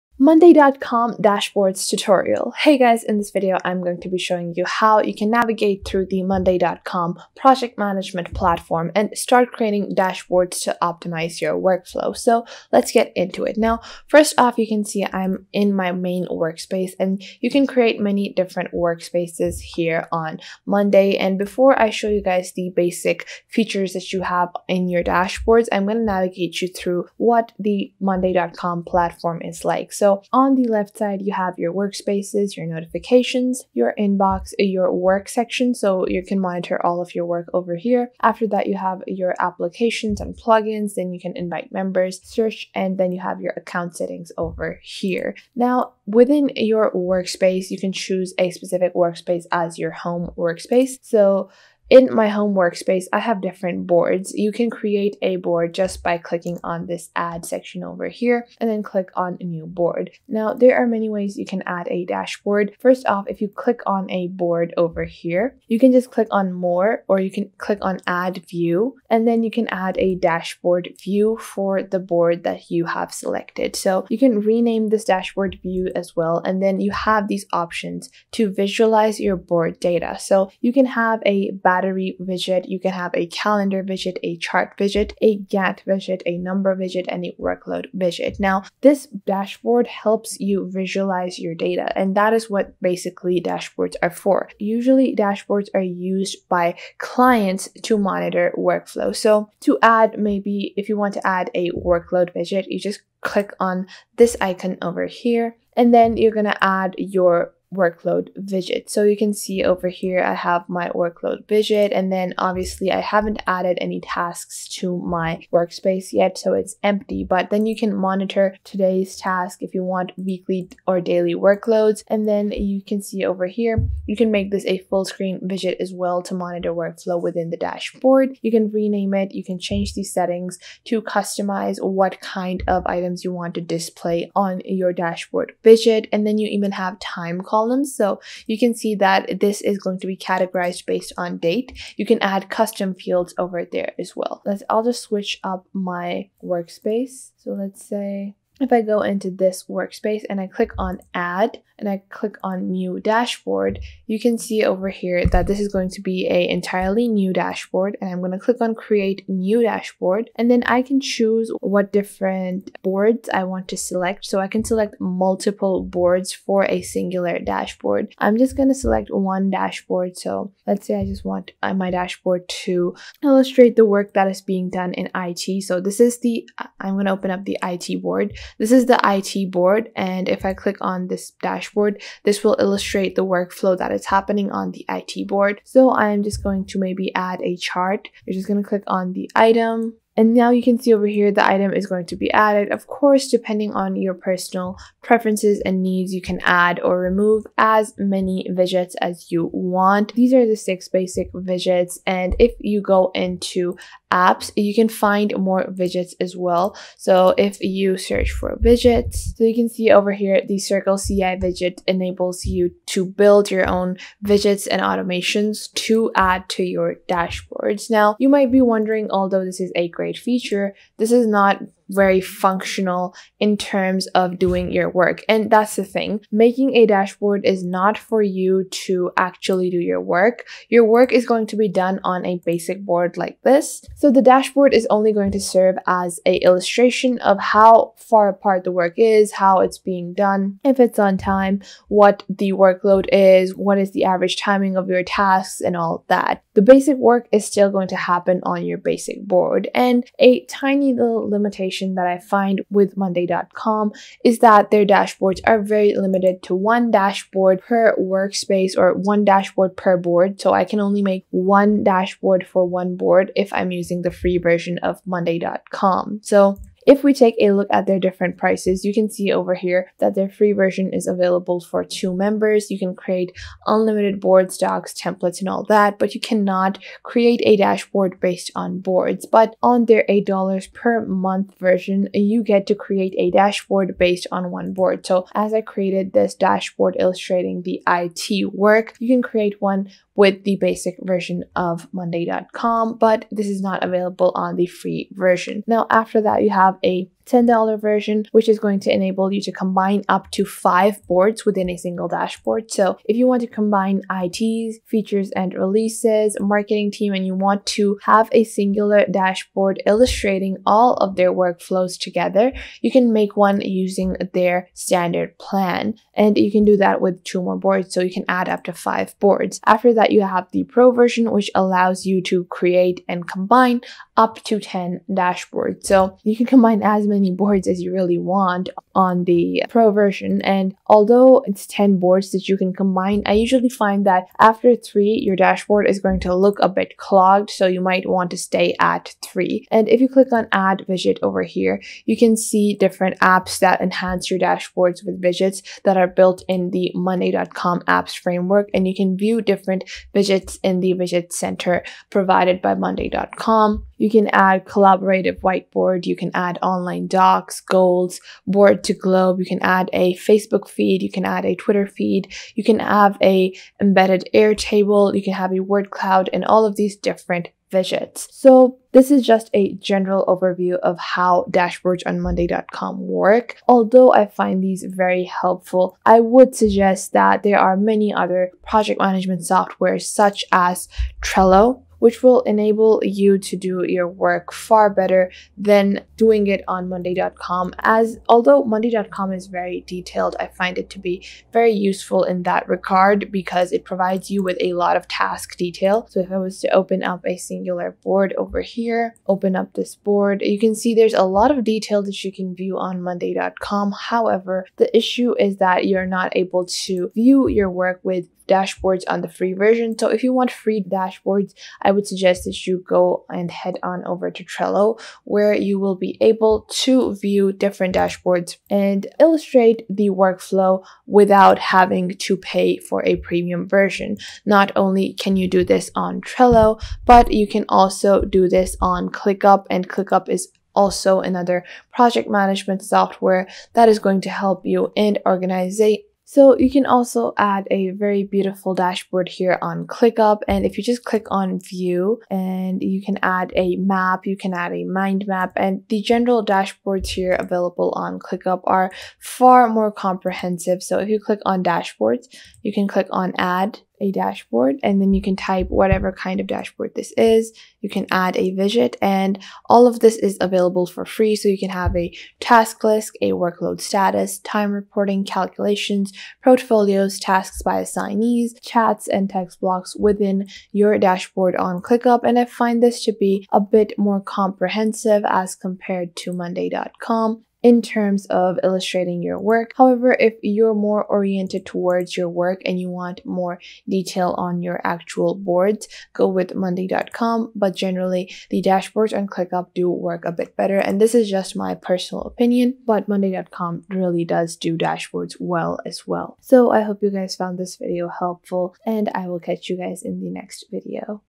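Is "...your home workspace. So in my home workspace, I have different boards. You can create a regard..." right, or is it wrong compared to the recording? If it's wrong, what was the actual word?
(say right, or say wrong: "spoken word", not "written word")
wrong: "board", not "regard".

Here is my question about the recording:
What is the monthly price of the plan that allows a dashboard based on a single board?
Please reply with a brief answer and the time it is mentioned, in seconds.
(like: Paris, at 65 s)
$8, at 280 s.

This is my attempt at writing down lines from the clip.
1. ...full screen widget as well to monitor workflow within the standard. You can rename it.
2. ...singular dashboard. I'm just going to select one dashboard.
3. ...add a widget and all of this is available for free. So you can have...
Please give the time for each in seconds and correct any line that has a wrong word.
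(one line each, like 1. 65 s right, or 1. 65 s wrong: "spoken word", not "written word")
1. 124 s wrong: "dashboard", not "standard"
2. 166 s right
3. 458 s right.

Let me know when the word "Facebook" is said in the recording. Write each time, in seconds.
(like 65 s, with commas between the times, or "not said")
360 s.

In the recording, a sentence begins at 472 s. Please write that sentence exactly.
And I find this to be a bit more comprehensive as compared to monday.com in terms of illustrating your work.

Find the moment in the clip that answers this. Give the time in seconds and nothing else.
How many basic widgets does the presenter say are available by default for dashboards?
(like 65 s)
200 s.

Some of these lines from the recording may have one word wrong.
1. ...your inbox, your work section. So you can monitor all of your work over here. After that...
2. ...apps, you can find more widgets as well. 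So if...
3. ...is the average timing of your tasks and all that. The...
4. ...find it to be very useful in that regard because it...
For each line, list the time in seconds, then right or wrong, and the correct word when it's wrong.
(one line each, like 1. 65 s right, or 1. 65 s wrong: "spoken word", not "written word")
1. 33 s right
2. 204 s right
3. 243 s right
4. 390 s right.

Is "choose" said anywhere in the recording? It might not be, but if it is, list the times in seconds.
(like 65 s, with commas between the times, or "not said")
47 s, 161 s.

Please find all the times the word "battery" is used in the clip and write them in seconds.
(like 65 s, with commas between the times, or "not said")
81 s.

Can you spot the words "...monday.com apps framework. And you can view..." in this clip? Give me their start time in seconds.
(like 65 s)
346 s.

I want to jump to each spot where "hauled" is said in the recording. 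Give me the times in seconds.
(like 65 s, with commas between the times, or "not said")
not said.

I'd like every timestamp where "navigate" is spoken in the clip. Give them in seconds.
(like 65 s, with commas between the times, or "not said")
5 s, 26 s.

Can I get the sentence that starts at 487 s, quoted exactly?
But generally, the dashboards on ClickUp do work a bit better.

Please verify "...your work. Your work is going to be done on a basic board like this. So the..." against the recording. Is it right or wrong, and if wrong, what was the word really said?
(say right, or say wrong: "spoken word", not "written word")
right.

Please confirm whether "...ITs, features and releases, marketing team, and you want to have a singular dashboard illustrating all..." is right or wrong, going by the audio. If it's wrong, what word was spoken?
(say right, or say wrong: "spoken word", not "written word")
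right.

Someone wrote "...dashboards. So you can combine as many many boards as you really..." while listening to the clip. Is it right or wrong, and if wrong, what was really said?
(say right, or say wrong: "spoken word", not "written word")
right.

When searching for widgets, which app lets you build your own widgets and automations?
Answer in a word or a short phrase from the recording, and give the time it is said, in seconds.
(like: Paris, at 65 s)
Circle CI, at 210 s.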